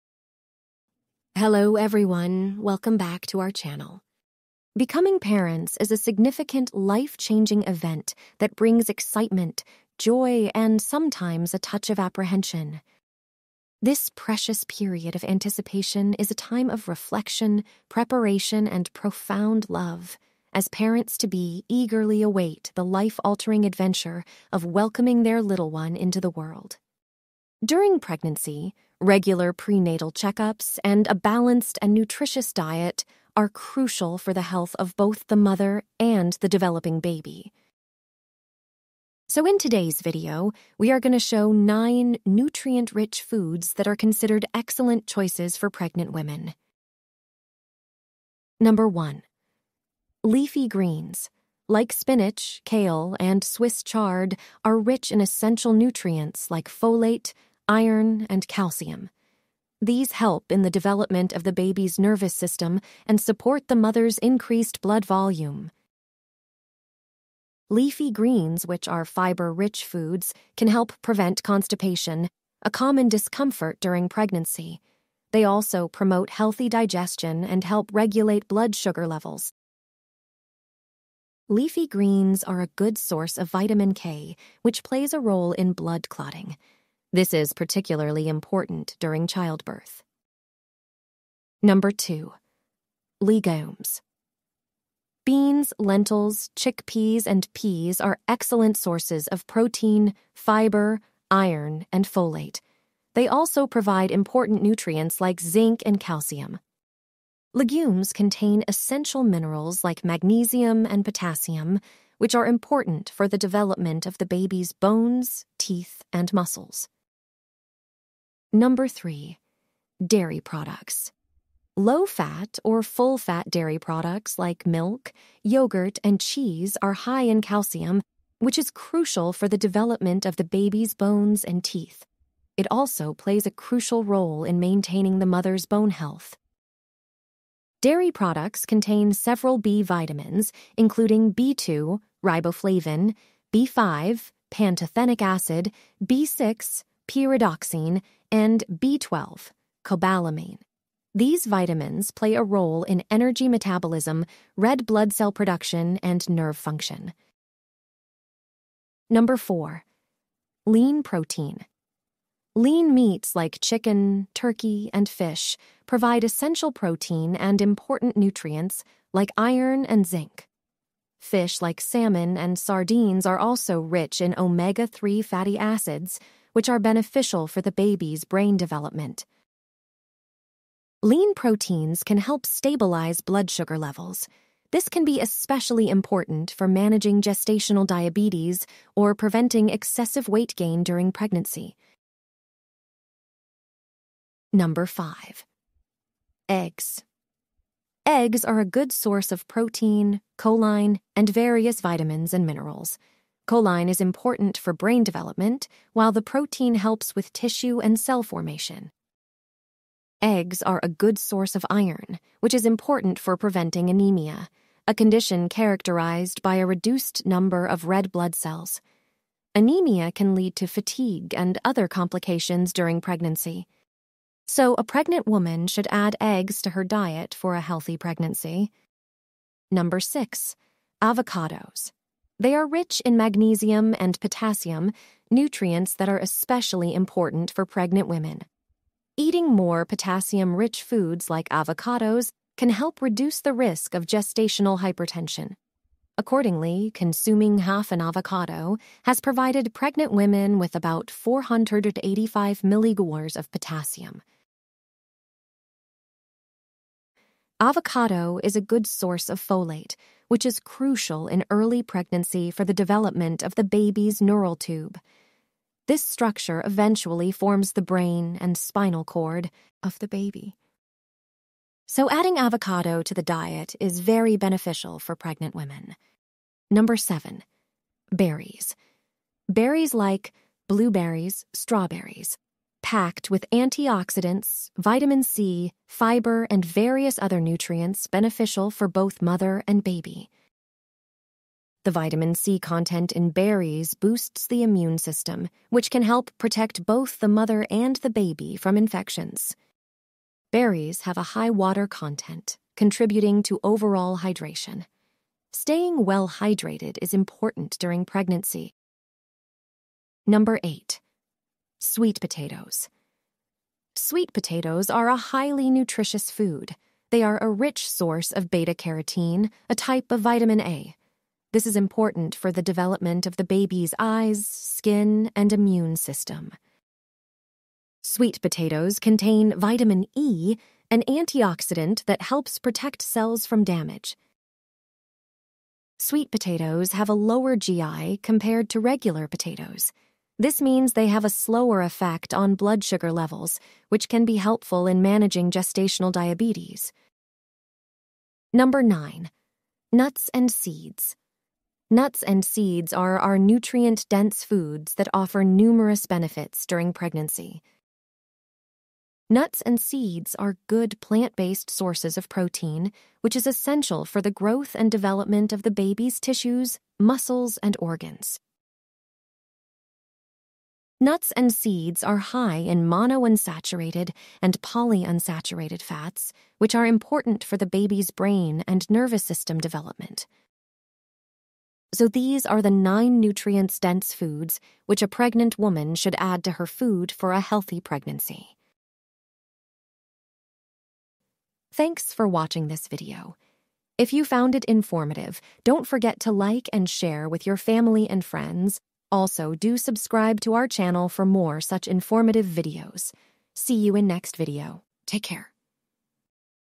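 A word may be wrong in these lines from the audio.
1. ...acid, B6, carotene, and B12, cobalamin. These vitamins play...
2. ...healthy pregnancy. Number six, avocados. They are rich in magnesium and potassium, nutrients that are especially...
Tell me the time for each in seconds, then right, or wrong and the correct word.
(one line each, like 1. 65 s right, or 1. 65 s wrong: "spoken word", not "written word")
1. 145 s wrong: "pyridoxine", not "carotene"
2. 227 s right.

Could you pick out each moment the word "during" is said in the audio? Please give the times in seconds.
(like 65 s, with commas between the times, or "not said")
27 s, 73 s, 88 s, 190 s, 222 s, 307 s, 356 s.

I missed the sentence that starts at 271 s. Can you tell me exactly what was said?
So, adding avocado to the diet is very beneficial for pregnant women.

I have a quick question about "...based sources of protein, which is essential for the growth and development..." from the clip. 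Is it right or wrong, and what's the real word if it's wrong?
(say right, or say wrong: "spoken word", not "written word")
right.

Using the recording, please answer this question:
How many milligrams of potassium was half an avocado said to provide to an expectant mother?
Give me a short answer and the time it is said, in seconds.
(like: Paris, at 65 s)
485, at 251 s.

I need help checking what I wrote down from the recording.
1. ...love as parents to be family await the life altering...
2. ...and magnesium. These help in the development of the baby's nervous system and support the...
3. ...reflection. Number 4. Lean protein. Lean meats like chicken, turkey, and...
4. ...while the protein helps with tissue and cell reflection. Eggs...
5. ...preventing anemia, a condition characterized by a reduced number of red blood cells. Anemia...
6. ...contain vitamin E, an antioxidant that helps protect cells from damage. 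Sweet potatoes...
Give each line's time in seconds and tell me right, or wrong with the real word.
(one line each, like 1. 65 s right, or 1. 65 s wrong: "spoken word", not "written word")
1. 19 s wrong: "eagerly", not "family"
2. 58 s wrong: "calcium", not "magnesium"
3. 156 s wrong: "function", not "reflection"
4. 205 s wrong: "formation", not "reflection"
5. 213 s right
6. 328 s right.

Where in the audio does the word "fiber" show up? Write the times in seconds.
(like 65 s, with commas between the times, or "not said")
69 s, 100 s, 285 s.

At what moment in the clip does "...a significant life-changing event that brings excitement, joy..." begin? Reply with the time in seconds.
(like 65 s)
5 s.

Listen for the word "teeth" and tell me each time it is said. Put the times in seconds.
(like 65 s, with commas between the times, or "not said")
115 s, 131 s.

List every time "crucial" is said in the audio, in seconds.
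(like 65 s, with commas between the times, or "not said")
33 s, 128 s, 133 s, 260 s.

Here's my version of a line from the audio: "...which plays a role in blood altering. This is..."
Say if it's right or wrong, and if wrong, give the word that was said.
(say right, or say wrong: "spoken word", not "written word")
wrong: "clotting", not "altering".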